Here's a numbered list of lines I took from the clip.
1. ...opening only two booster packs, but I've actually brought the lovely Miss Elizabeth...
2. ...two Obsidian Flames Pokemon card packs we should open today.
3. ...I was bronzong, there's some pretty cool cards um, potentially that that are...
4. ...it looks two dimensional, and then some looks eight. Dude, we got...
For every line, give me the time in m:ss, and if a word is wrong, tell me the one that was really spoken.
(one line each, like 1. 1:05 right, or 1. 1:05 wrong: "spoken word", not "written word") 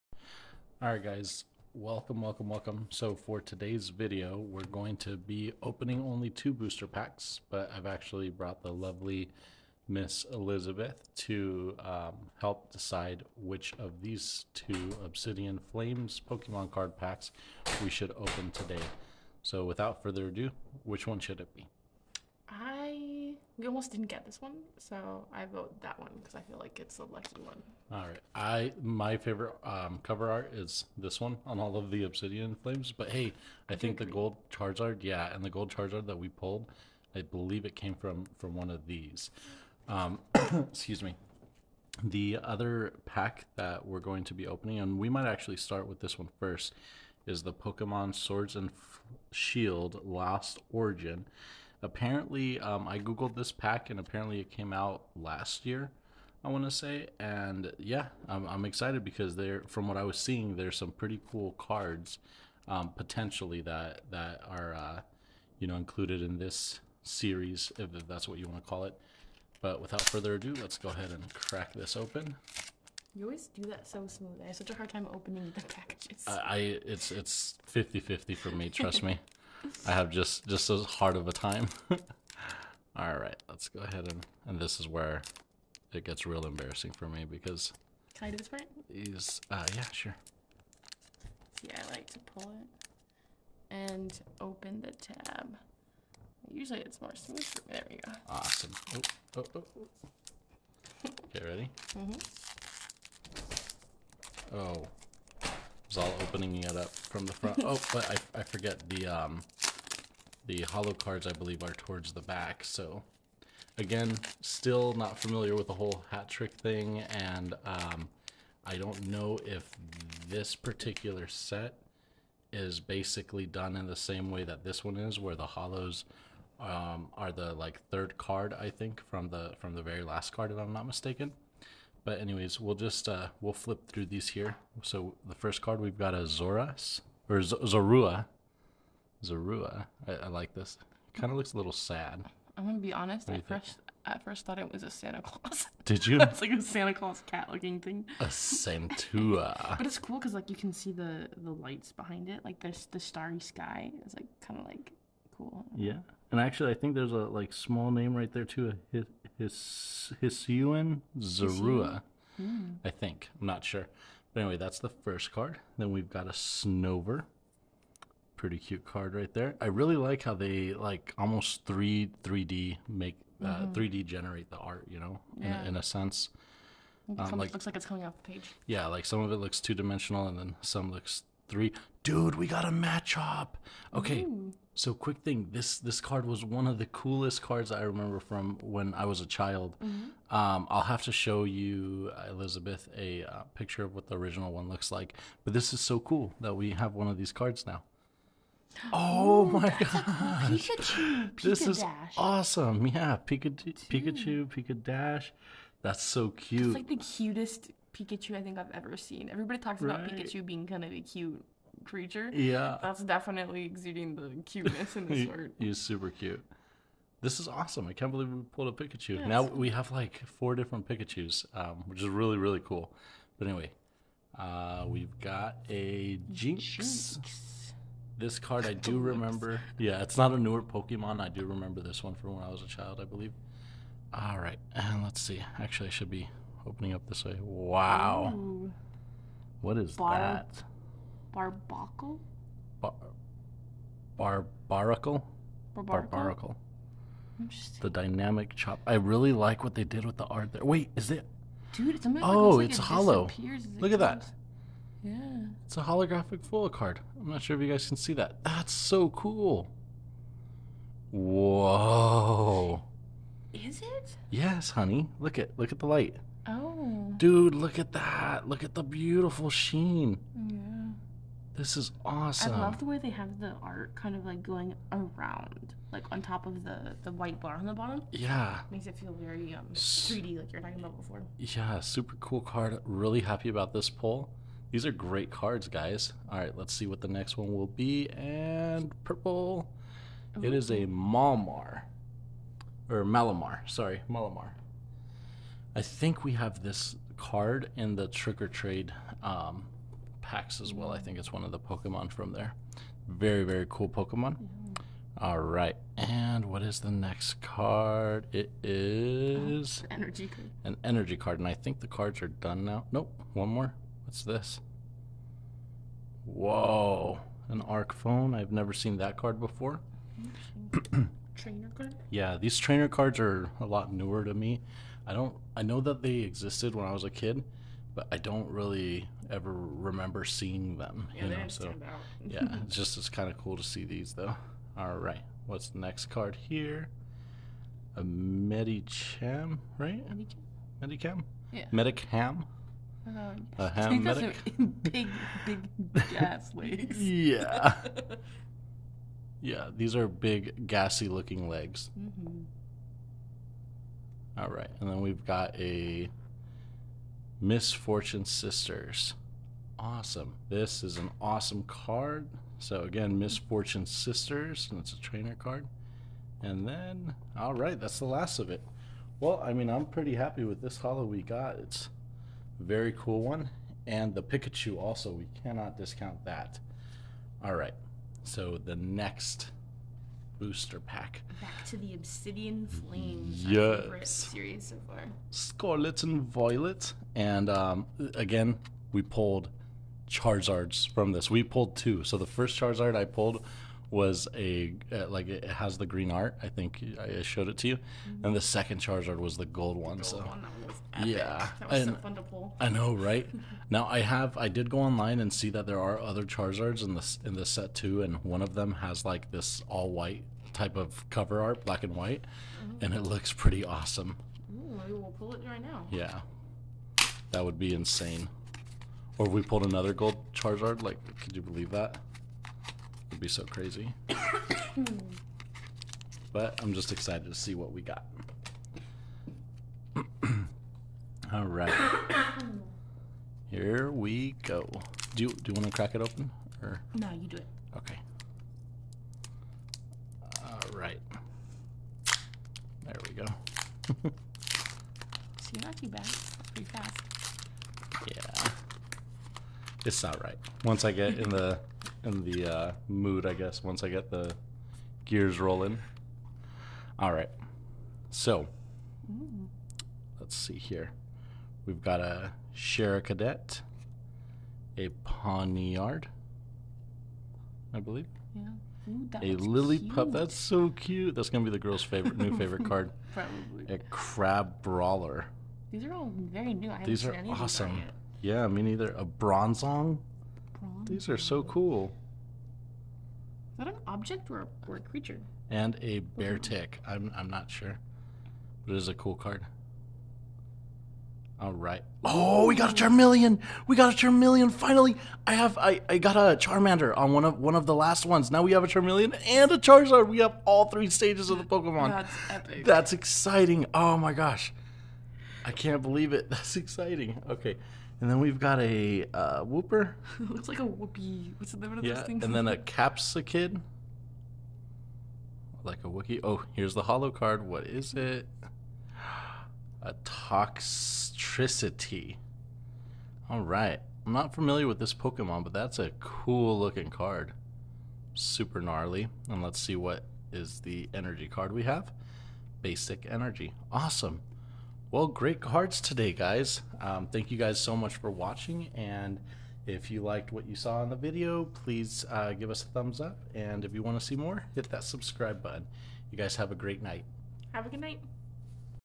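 1. 0:05 right
2. 0:14 right
3. 0:59 wrong: "seeing", not "bronzong"
4. 2:59 wrong: "three", not "eight".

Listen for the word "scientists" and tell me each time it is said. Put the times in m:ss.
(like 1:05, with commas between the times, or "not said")
not said.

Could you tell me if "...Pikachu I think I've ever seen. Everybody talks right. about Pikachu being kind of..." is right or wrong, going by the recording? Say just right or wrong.
right.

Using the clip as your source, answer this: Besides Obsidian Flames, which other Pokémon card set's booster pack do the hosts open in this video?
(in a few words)
Lost Origin.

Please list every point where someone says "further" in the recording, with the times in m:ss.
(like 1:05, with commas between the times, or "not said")
0:20, 1:10.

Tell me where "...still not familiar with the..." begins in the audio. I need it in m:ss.
1:54.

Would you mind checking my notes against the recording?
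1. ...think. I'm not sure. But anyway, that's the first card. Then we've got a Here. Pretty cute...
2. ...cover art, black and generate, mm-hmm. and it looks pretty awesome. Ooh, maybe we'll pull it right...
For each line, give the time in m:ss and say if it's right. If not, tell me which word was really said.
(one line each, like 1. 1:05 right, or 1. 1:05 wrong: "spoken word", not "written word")
1. 2:42 wrong: "Snover", not "Here"
2. 6:51 wrong: "white", not "generate".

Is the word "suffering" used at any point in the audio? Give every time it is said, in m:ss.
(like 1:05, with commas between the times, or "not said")
not said.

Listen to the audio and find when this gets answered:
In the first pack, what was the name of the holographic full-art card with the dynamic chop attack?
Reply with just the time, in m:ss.
4:01.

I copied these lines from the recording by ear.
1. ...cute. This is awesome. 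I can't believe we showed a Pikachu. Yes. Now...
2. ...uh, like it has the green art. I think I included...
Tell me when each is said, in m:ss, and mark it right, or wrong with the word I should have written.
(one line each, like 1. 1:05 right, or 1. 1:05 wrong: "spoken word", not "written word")
1. 3:36 wrong: "pulled", not "showed"
2. 6:34 wrong: "showed", not "included".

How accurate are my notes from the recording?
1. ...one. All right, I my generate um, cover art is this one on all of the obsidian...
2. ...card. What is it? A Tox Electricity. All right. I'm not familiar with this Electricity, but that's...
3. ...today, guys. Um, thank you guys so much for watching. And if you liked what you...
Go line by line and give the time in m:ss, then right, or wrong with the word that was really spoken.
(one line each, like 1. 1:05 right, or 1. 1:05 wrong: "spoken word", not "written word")
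1. 0:27 wrong: "favorite", not "generate"
2. 8:37 wrong: "Pokemon", not "Electricity"
3. 8:55 right.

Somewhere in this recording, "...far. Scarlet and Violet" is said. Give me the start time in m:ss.
6:24.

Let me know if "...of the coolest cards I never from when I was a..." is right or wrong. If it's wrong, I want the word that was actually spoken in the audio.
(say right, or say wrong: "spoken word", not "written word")
wrong: "remember", not "never".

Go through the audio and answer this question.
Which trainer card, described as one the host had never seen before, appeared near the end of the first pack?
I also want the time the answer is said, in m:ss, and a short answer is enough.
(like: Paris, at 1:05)
Arc Phone, at 5:17.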